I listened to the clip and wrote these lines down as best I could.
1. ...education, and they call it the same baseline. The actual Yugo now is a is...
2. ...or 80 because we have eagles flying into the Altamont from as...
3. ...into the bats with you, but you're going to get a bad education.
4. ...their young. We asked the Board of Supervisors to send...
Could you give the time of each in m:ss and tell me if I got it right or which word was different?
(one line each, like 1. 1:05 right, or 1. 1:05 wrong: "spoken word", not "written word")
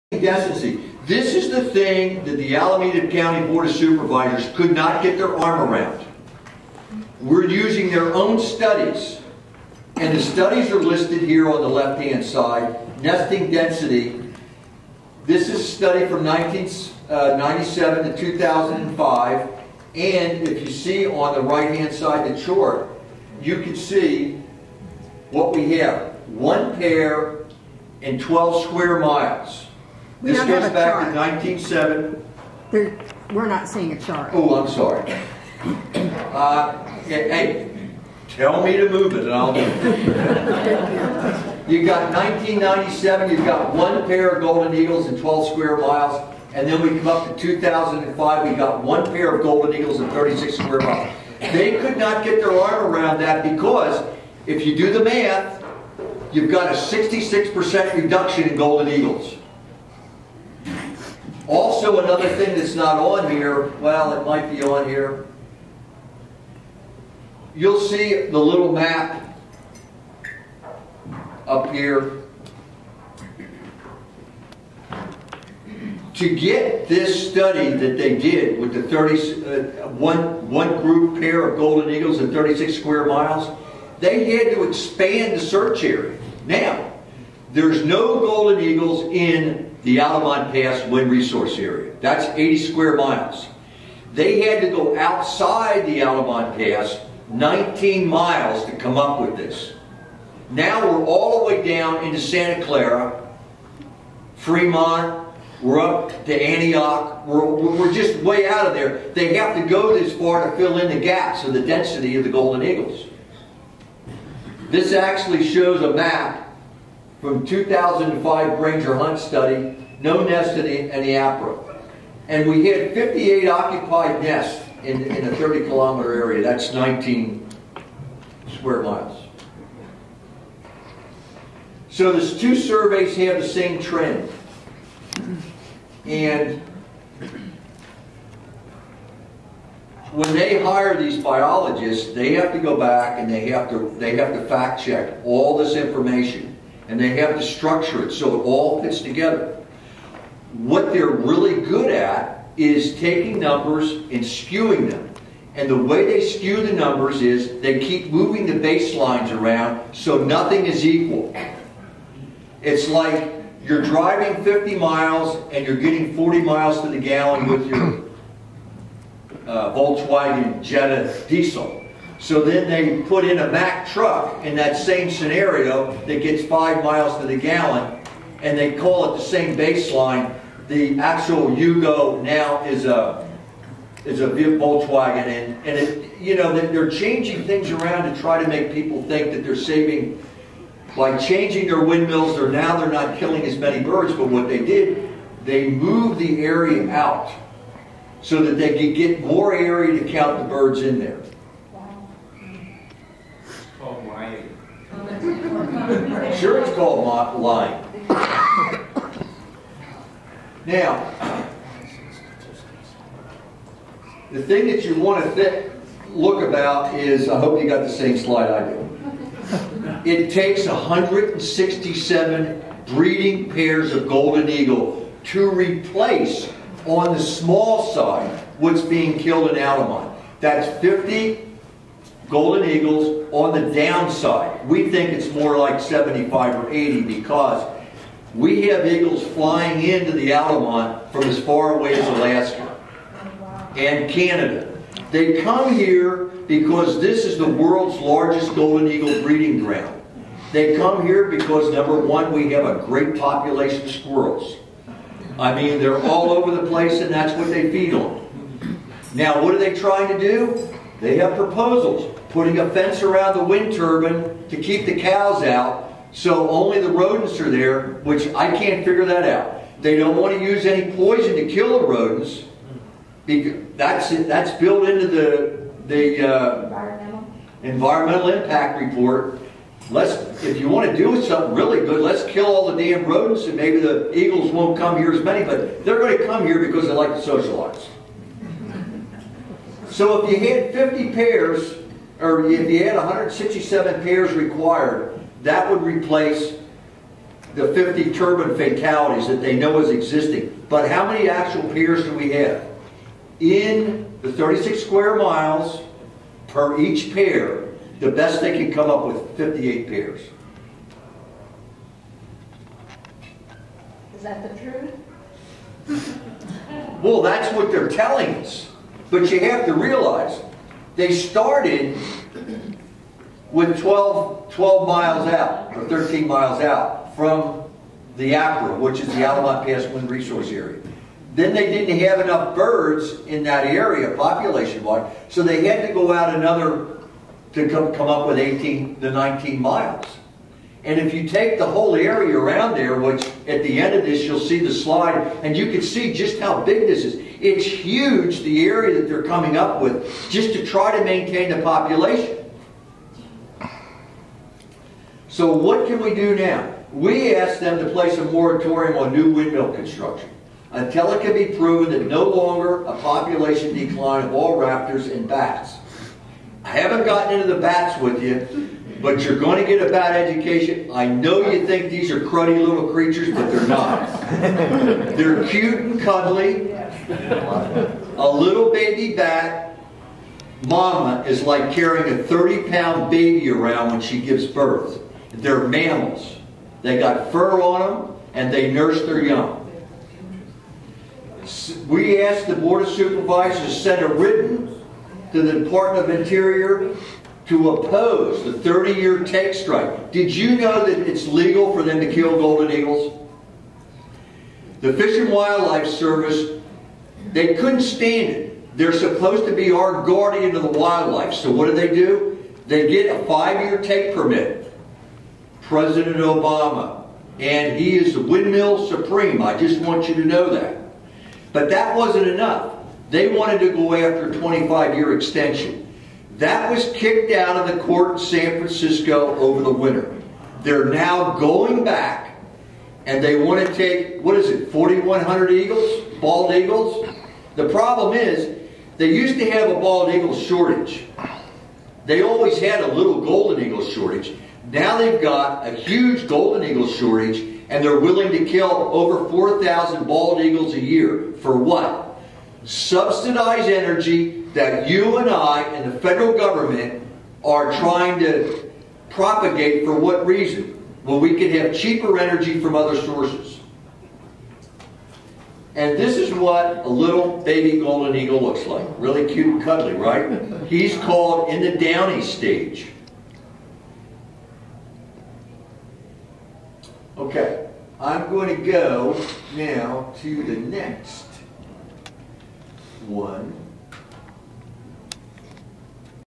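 1. 2:57 wrong: "gallon", not "education"
2. 3:56 right
3. 6:07 right
4. 6:29 right.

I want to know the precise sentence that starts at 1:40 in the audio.
Now we're all the way down into Santa Clara, Fremont, we're up to Antioch, we're, we're just way out of there.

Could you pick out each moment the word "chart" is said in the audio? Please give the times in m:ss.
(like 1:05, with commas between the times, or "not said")
0:22, 0:33.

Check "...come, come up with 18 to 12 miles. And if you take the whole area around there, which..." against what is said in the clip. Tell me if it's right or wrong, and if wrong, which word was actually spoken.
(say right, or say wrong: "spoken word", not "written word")
wrong: "19", not "12".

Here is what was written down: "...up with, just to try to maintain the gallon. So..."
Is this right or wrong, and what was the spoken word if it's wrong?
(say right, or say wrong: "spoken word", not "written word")
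wrong: "population", not "gallon".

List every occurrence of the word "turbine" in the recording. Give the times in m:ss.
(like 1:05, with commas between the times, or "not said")
4:23, 4:58.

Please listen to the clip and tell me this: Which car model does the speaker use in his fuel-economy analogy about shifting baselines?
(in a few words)
Volkswagen Jetta diesel.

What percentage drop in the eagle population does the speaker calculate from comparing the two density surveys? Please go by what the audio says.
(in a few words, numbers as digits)
66%.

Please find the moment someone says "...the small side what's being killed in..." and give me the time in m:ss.
3:47.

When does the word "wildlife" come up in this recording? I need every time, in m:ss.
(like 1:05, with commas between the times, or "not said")
6:45, 6:50.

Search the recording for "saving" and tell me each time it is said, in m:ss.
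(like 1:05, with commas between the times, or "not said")
3:09.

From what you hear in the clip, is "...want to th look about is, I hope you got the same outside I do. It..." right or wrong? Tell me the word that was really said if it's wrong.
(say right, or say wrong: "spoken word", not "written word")
wrong: "slide", not "outside".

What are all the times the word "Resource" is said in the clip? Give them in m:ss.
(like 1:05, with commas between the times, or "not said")
1:31, 5:30.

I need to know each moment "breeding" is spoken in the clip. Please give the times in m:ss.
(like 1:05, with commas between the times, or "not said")
3:42, 4:09.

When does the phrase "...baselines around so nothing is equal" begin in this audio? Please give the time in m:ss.
2:38.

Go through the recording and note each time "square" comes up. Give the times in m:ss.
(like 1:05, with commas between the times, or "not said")
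0:28, 0:45, 0:50, 1:22, 1:32, 2:08, 5:04.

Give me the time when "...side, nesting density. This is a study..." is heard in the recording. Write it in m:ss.
0:12.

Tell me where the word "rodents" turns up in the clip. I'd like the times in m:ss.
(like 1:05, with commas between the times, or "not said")
4:26, 4:31, 4:43.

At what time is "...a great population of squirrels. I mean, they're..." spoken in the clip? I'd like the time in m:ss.
4:12.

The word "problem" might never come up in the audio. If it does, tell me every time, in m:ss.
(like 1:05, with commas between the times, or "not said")
7:17.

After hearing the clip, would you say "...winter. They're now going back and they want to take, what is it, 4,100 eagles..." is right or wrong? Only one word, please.
right.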